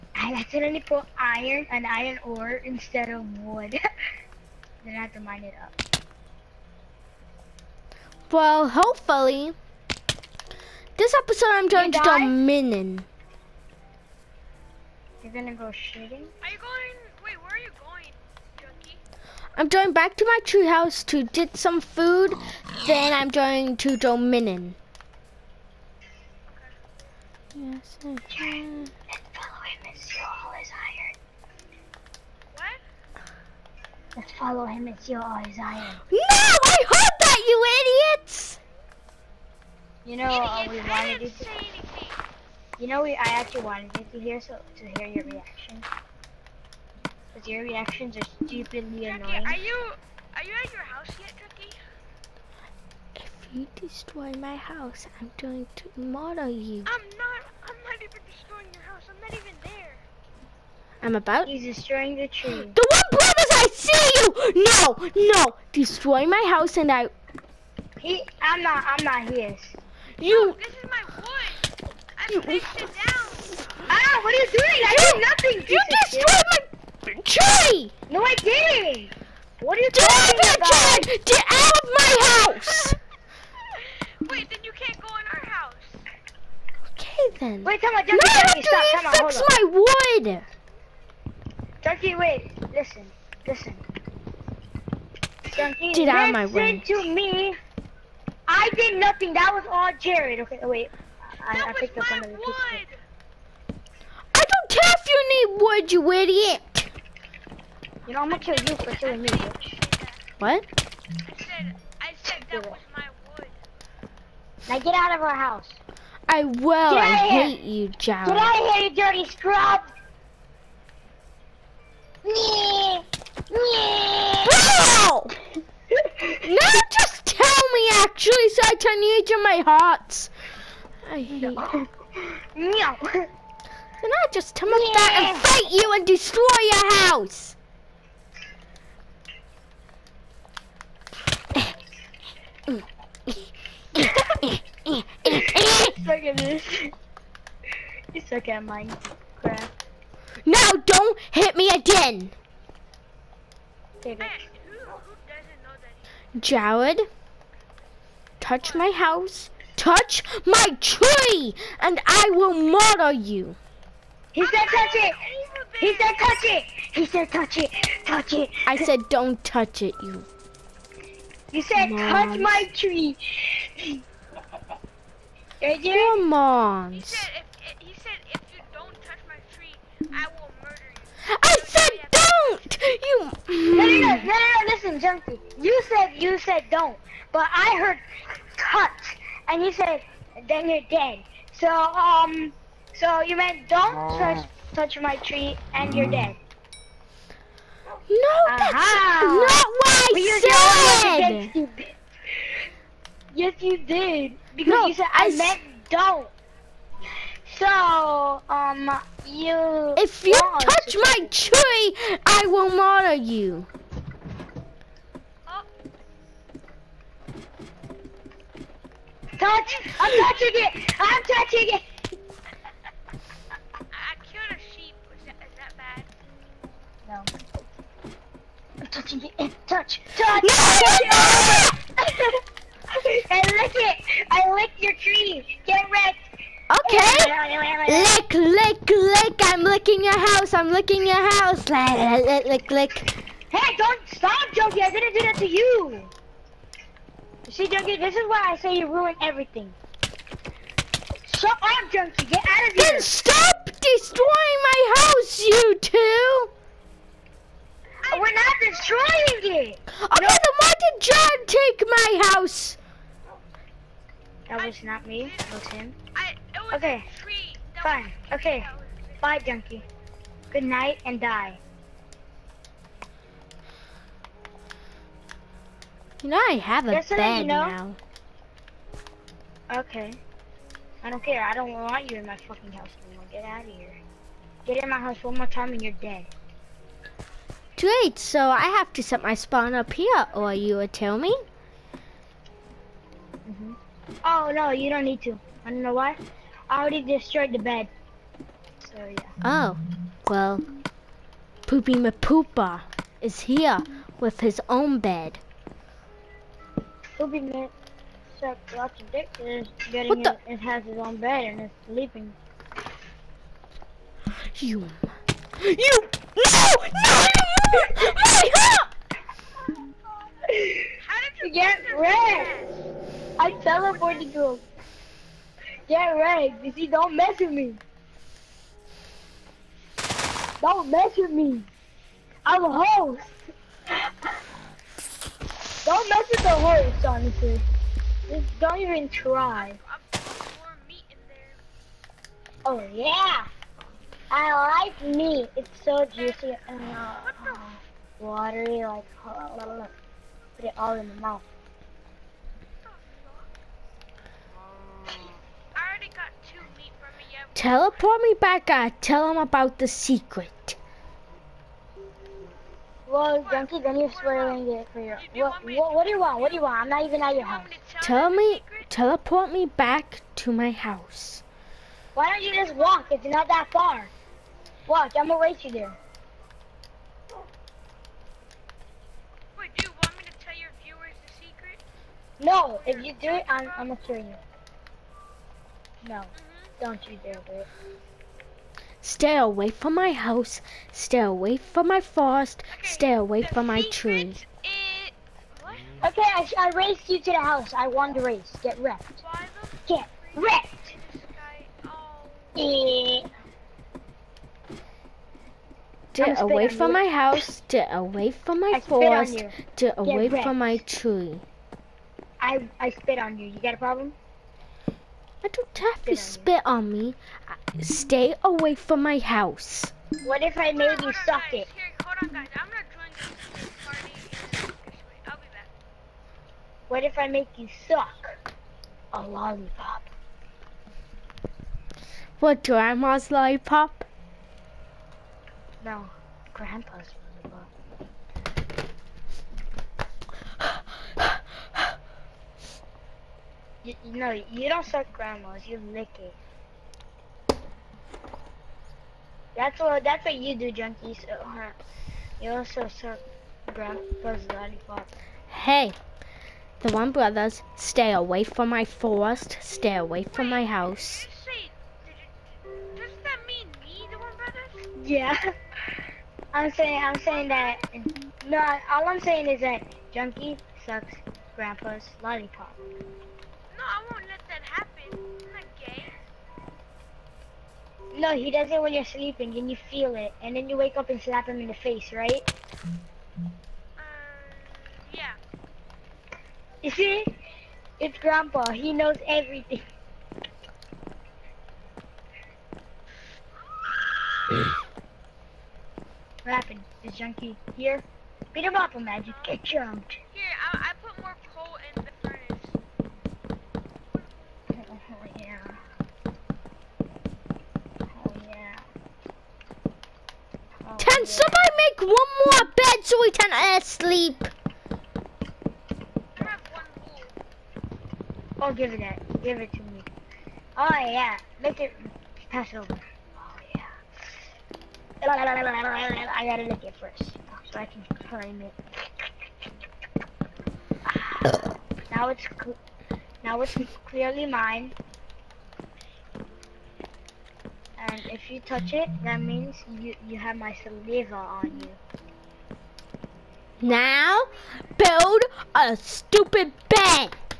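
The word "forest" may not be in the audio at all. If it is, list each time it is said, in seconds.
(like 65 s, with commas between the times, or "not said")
392 s, 408 s, 458 s.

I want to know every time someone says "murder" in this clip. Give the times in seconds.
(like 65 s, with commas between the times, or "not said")
55 s, 162 s, 180 s, 212 s.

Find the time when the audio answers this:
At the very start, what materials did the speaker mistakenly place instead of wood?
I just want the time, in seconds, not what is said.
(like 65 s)
1 s.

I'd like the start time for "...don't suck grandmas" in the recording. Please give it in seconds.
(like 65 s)
444 s.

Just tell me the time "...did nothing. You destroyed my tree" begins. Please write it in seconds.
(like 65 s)
75 s.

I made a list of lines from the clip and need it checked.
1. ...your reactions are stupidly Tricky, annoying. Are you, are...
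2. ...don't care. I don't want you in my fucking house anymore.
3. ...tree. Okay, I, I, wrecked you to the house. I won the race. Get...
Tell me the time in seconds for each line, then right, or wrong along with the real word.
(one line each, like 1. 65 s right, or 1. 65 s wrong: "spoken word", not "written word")
1. 47 s right
2. 281 s right
3. 393 s wrong: "raced", not "wrecked".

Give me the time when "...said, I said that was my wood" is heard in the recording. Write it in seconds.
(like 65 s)
111 s.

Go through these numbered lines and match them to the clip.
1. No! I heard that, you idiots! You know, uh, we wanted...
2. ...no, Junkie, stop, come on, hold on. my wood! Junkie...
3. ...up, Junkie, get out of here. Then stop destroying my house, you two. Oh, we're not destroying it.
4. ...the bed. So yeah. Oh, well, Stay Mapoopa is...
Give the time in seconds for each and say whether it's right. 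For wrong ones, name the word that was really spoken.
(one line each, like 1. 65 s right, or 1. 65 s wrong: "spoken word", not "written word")
1. 36 s right
2. 88 s right
3. 251 s right
4. 297 s wrong: "Poopy", not "Stay".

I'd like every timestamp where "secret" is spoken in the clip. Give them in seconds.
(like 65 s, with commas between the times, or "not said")
359 s, 381 s.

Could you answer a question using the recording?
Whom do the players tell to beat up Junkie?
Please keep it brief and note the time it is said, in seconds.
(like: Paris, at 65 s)
Magic, at 498 s.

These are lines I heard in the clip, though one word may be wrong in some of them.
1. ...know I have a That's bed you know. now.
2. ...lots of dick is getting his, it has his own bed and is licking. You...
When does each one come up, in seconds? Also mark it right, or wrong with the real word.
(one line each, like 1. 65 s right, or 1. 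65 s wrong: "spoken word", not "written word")
1. 276 s right
2. 308 s wrong: "sleeping", not "licking".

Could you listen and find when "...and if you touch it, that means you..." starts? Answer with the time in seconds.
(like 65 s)
538 s.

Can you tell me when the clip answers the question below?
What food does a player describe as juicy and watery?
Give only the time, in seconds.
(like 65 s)
345 s.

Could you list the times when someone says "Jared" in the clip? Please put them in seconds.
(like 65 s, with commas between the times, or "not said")
99 s, 117 s, 156 s.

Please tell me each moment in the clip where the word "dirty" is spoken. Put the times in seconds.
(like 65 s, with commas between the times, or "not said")
118 s.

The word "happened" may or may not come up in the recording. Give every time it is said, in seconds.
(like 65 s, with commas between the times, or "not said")
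496 s.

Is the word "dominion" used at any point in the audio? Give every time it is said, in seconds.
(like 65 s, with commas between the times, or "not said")
12 s, 23 s.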